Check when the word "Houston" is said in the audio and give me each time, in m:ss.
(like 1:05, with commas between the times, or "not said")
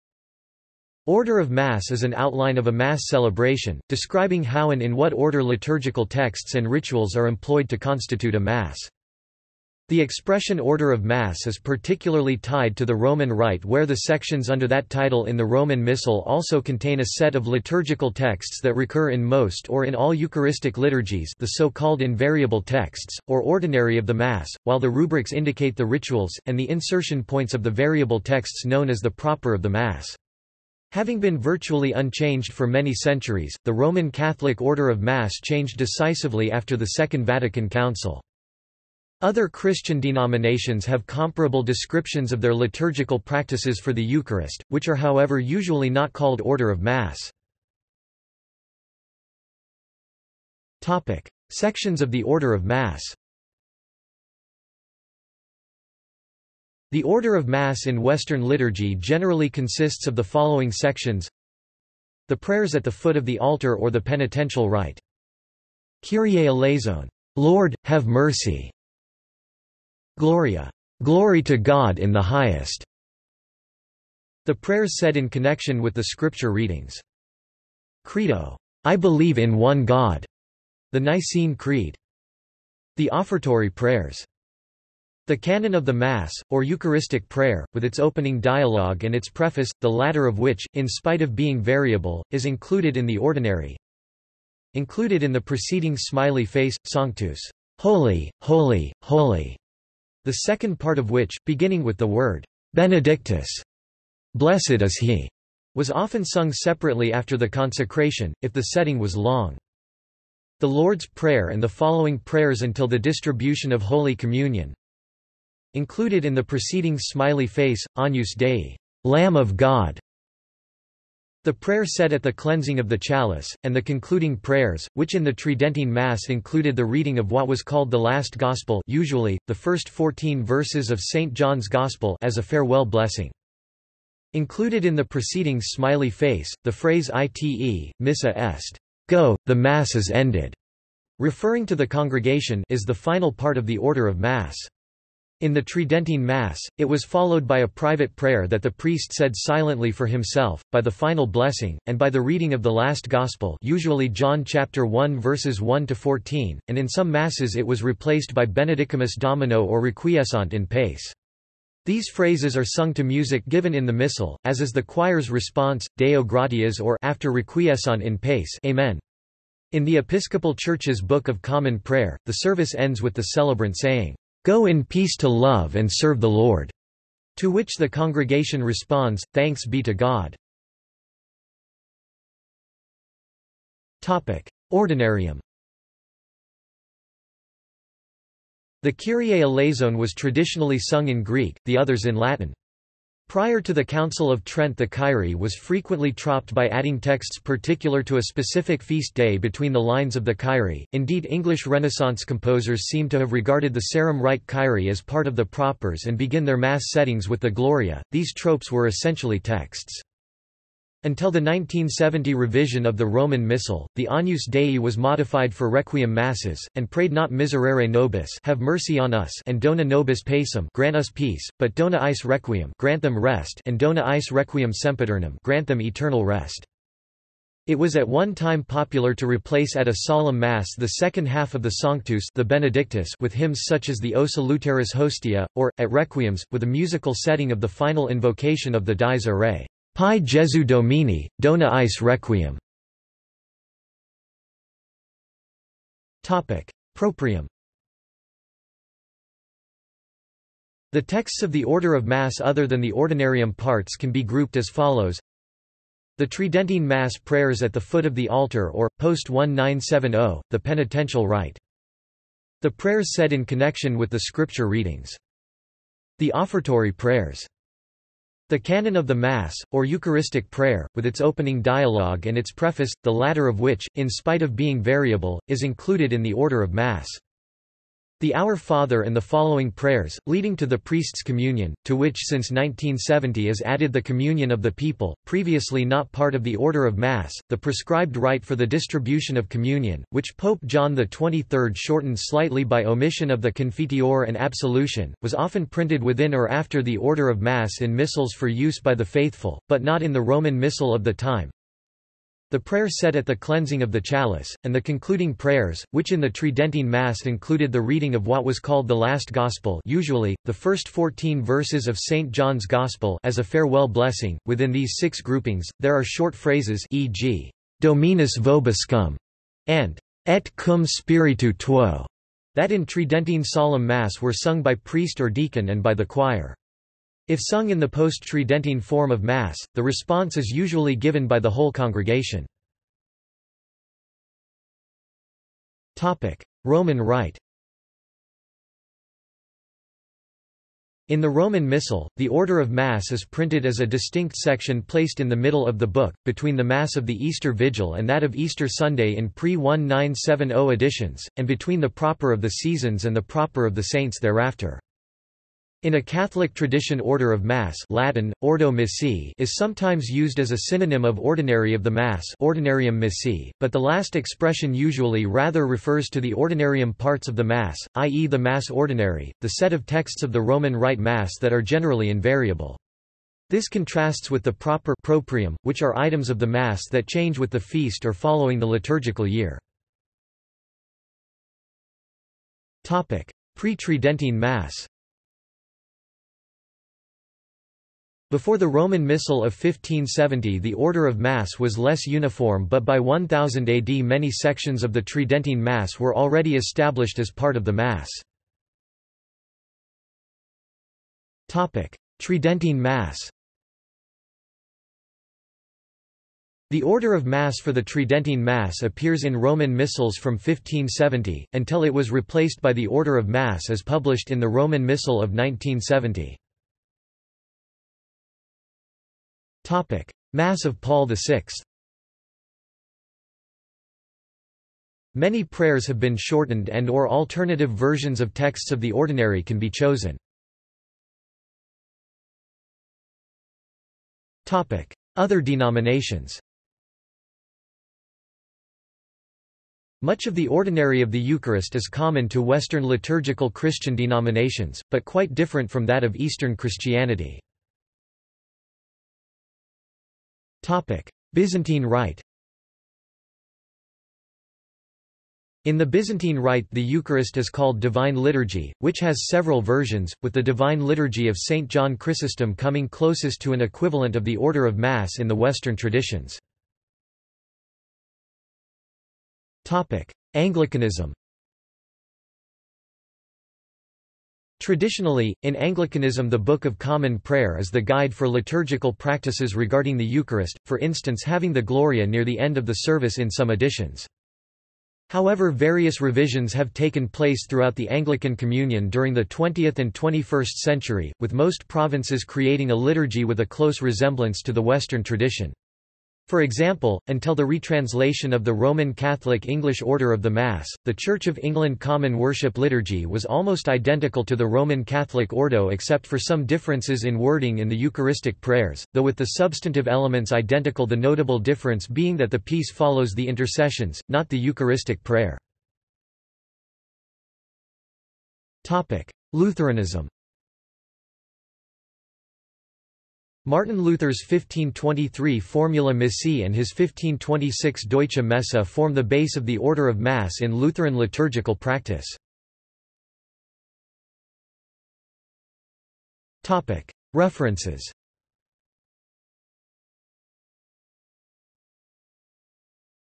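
not said.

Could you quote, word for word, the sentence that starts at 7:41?
John Chrysostom coming closest to an equivalent of the Order of Mass in the Western traditions.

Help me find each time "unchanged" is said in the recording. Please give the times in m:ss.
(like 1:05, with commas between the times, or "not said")
0:31.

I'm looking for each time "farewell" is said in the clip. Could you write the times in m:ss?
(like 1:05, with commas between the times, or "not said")
2:12, 5:13.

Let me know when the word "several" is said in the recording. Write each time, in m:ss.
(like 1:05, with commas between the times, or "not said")
7:39.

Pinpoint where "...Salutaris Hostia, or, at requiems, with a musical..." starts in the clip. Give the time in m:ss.
3:54.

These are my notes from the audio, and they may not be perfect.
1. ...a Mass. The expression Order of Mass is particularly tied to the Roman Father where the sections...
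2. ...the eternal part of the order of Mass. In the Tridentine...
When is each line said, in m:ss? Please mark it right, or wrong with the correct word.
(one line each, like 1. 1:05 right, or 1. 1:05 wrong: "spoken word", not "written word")
1. 0:08 wrong: "Rite", not "Father"
2. 2:22 wrong: "final", not "eternal".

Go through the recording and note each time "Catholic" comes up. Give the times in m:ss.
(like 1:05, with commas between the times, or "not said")
0:34, 5:56, 8:18, 8:24.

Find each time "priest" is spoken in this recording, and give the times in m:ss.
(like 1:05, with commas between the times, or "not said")
2:28, 4:40, 5:24.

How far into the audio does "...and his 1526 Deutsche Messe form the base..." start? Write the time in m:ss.
8:46.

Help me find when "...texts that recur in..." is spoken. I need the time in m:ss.
0:18.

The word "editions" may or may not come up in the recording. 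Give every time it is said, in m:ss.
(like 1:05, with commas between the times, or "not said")
5:50, 8:03.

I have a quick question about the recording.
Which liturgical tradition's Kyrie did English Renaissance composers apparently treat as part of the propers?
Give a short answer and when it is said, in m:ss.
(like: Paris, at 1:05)
Sarum Rite, at 3:23.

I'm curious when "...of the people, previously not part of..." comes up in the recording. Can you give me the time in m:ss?
4:44.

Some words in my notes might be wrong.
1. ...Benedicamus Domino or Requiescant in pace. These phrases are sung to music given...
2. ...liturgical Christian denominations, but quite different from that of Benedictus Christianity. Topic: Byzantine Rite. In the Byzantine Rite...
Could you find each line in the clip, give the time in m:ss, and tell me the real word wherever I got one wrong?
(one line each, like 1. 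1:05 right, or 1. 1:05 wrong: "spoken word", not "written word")
1. 2:38 right
2. 7:22 wrong: "Eastern", not "Benedictus".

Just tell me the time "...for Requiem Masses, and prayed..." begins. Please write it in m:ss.
3:35.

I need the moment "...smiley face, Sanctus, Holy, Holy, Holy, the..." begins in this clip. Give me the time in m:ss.
1:35.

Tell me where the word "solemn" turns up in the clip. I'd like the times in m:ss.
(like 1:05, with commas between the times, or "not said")
3:50, 5:23.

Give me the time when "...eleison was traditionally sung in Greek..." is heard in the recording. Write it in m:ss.
3:09.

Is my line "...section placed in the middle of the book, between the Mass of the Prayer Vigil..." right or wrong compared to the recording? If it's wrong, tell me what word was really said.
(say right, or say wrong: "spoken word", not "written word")
wrong: "Easter", not "Prayer".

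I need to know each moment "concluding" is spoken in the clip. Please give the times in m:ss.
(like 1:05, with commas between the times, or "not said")
2:03, 5:04.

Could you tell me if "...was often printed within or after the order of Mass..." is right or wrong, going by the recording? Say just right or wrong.
right.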